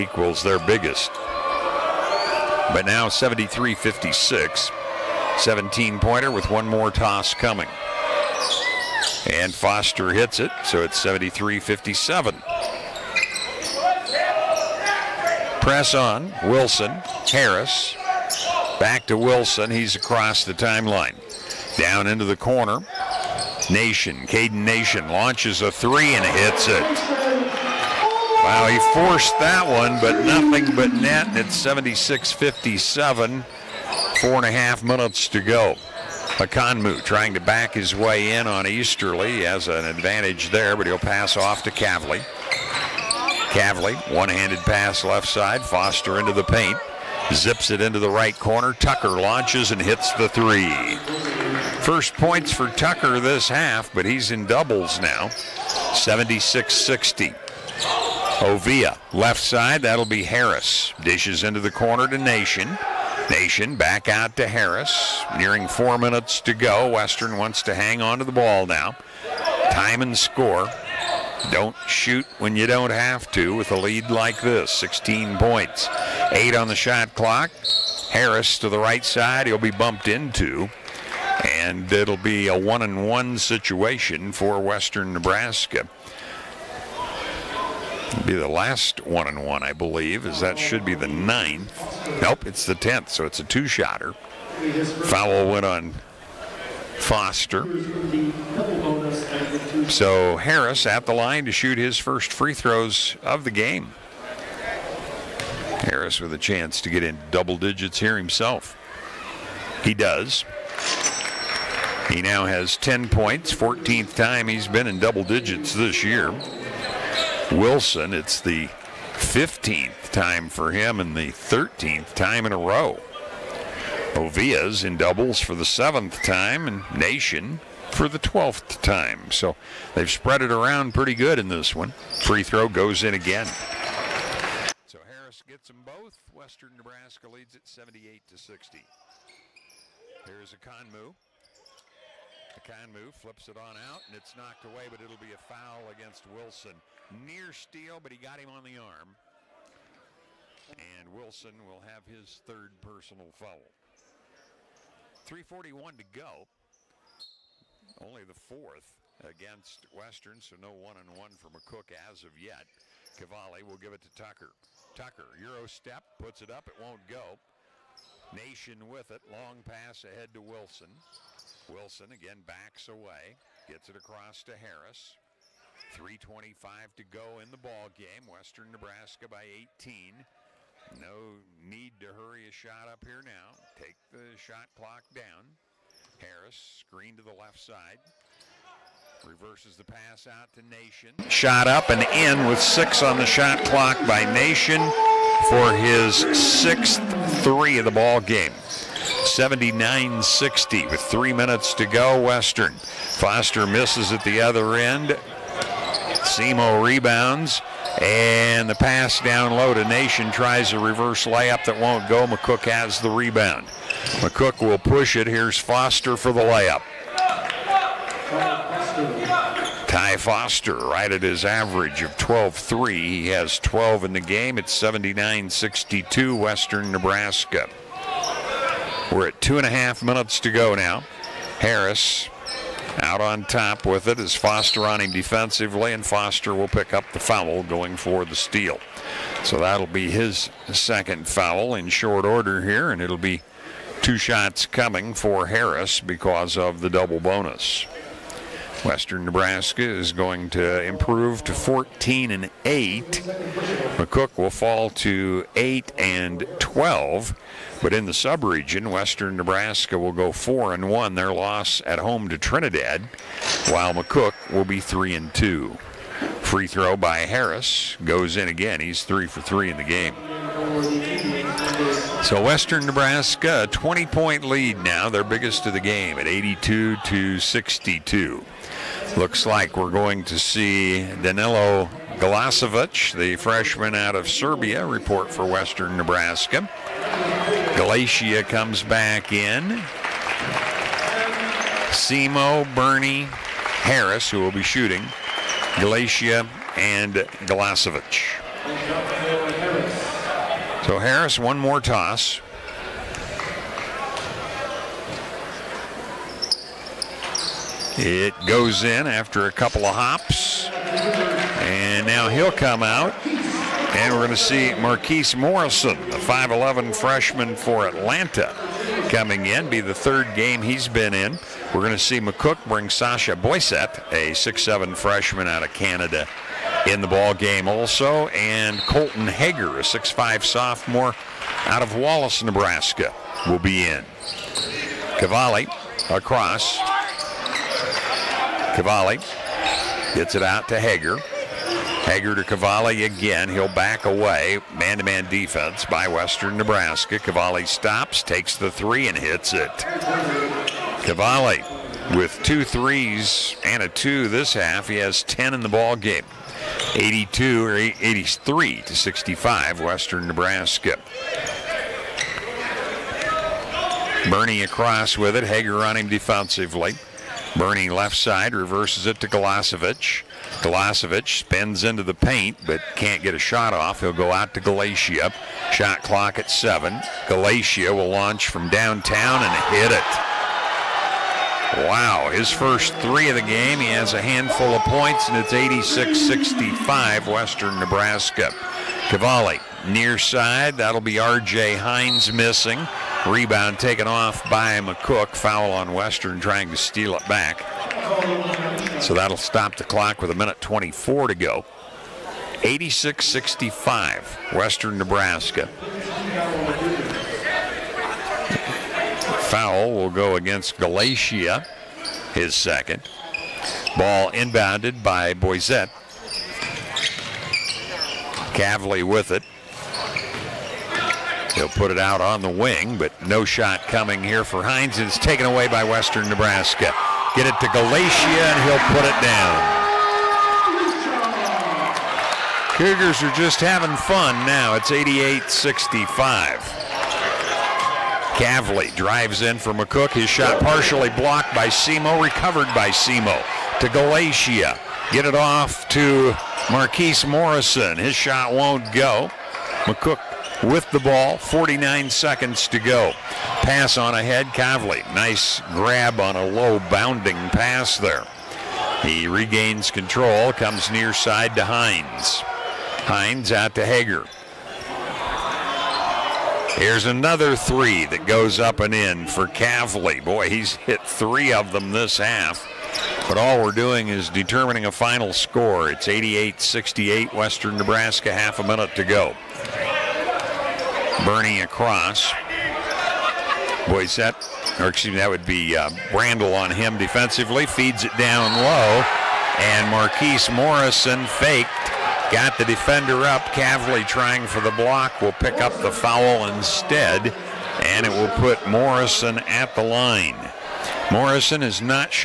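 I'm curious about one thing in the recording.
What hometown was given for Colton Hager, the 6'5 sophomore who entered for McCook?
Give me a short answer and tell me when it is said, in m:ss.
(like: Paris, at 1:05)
Wallace, Nebraska, at 5:31.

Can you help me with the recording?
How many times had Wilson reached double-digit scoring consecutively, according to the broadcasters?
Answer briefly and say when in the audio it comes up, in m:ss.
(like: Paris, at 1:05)
13, at 2:01.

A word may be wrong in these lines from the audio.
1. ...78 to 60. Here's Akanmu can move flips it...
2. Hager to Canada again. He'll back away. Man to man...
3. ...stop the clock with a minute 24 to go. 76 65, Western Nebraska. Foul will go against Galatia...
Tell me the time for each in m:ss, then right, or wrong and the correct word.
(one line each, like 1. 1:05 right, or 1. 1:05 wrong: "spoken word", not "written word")
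1. 2:17 right
2. 5:42 wrong: "Cavalli", not "Canada"
3. 6:39 wrong: "86", not "76".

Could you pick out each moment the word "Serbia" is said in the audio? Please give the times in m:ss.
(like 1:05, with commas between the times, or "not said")
4:44.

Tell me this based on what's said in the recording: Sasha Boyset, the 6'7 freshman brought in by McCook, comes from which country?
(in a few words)
Canada.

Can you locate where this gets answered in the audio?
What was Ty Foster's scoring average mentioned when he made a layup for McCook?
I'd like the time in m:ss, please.
3:42.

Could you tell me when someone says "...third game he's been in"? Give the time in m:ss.
5:19.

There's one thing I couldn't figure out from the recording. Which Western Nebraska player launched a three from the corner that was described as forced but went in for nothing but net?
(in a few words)
Caden Nation.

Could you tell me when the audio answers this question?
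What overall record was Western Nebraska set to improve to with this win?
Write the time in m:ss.
4:11.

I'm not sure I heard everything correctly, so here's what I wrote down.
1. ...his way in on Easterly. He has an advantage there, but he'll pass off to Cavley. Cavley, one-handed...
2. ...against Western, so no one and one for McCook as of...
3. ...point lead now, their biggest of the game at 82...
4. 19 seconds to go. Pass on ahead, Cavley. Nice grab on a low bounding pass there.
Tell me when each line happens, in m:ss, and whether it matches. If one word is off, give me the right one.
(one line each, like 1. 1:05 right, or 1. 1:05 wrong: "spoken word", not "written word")
1. 0:37 right
2. 2:39 right
3. 4:34 right
4. 7:31 wrong: "49", not "19".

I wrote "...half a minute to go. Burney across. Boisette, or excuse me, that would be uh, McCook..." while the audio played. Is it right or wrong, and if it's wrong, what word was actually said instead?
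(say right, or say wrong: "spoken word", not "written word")
wrong: "Brandel", not "McCook".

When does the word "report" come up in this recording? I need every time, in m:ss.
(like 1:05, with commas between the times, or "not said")
4:44.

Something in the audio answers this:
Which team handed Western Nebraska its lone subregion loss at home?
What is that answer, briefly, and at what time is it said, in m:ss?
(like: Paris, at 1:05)
Trinidad, at 4:22.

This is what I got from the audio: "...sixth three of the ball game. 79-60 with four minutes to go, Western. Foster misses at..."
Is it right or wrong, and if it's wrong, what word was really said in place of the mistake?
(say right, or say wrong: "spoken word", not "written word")
wrong: "three", not "four".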